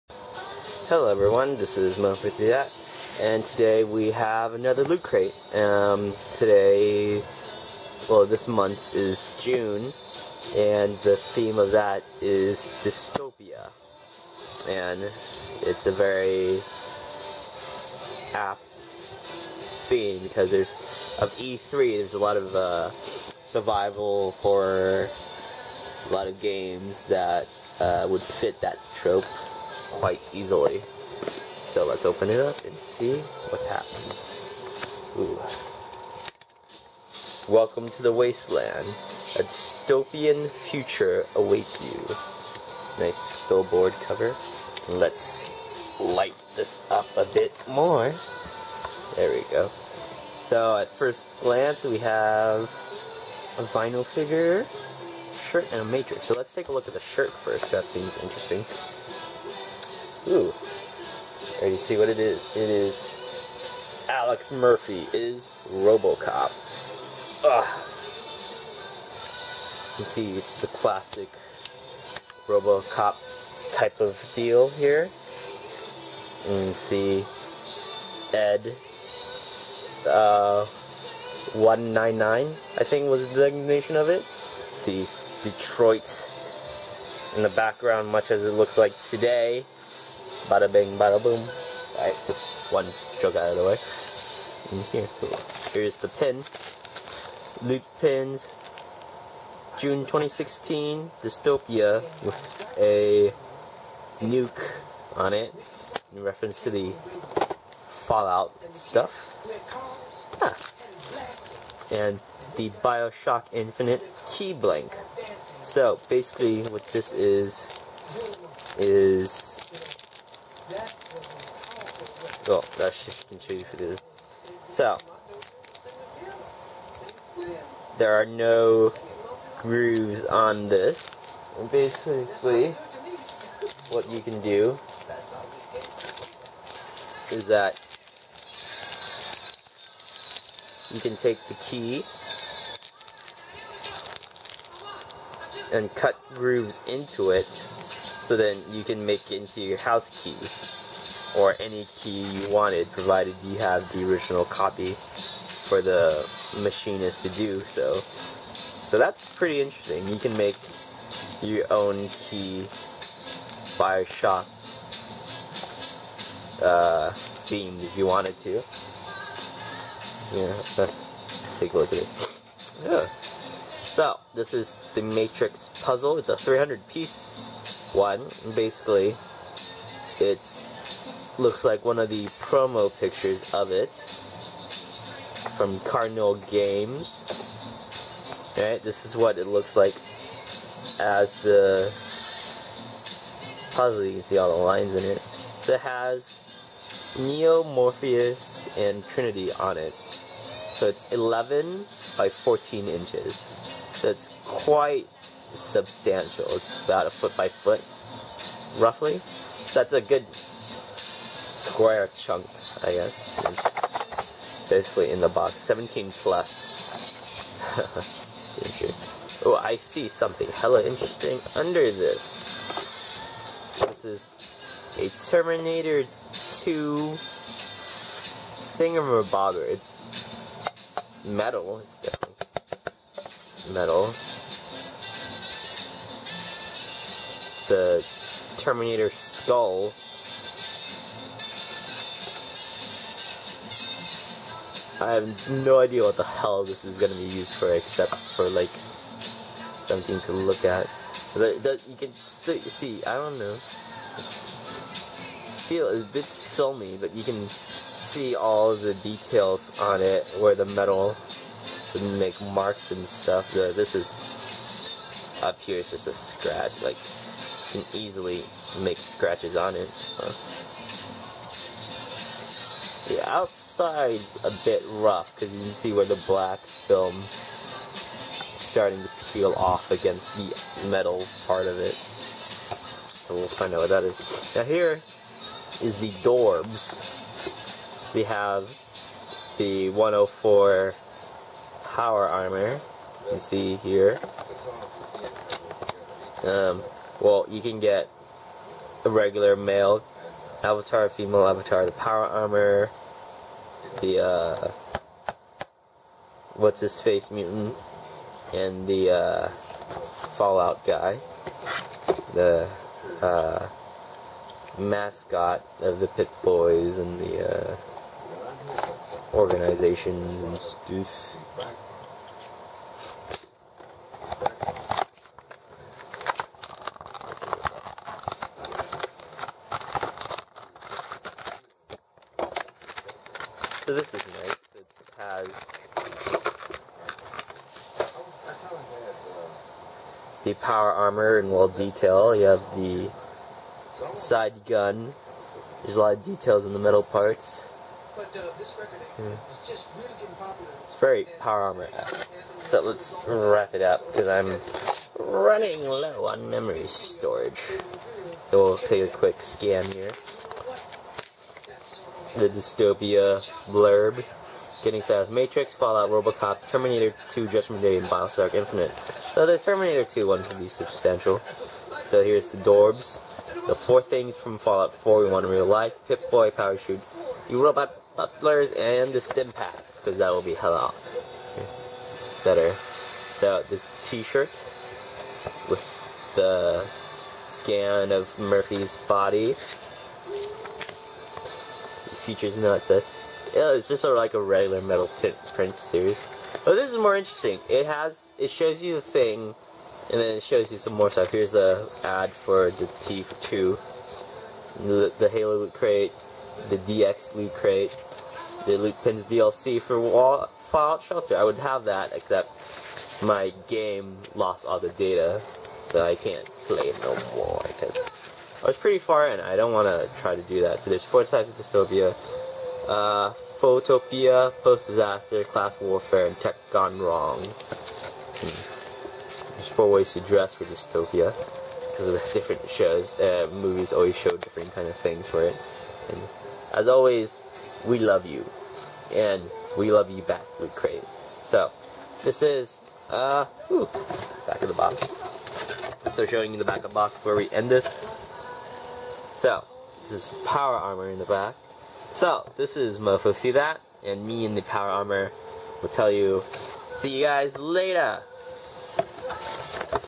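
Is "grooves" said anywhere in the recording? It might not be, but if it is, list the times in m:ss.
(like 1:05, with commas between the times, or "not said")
2:09, 2:26.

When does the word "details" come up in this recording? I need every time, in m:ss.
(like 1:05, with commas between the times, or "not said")
4:18, 5:41, 5:46.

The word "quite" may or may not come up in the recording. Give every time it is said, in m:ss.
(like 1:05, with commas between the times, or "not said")
0:29, 3:24.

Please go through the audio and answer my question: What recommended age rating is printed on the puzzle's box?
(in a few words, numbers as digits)
17 plus.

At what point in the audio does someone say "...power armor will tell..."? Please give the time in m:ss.
7:34.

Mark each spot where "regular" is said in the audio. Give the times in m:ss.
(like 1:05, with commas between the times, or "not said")
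4:59, 6:34.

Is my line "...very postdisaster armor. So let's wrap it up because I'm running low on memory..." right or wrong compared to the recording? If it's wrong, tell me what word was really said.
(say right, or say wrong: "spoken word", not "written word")
wrong: "power", not "postdisaster".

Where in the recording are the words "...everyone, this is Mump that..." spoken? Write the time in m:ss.
0:01.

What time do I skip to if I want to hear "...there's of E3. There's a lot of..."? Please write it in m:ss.
0:20.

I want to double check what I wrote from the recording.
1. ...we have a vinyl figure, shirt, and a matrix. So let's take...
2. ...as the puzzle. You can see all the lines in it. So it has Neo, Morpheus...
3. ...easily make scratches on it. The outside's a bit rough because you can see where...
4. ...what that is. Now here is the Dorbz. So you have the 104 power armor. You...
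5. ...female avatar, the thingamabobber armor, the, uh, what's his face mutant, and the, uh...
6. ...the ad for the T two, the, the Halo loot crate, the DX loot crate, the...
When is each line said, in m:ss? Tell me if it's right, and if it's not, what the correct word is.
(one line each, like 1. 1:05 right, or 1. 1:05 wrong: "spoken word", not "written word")
1. 0:51 right
2. 3:10 right
3. 4:27 right
4. 4:43 right
5. 5:01 wrong: "power", not "thingamabobber"
6. 6:41 right.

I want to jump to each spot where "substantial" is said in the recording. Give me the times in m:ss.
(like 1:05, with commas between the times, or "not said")
3:25, 6:10.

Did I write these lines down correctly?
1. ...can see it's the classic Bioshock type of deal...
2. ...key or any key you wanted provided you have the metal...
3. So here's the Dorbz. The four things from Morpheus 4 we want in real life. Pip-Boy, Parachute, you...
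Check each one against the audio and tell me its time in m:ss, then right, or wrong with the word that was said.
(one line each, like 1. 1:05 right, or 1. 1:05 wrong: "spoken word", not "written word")
1. 1:09 wrong: "Robocop", not "Bioshock"
2. 2:30 wrong: "original", not "metal"
3. 6:12 wrong: "Fallout", not "Morpheus".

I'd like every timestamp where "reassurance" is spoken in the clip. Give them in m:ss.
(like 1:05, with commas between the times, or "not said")
not said.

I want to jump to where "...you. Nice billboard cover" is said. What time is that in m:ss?
0:41.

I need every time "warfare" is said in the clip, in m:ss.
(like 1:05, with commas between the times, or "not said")
7:05.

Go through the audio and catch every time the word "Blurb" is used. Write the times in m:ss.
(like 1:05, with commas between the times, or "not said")
6:03.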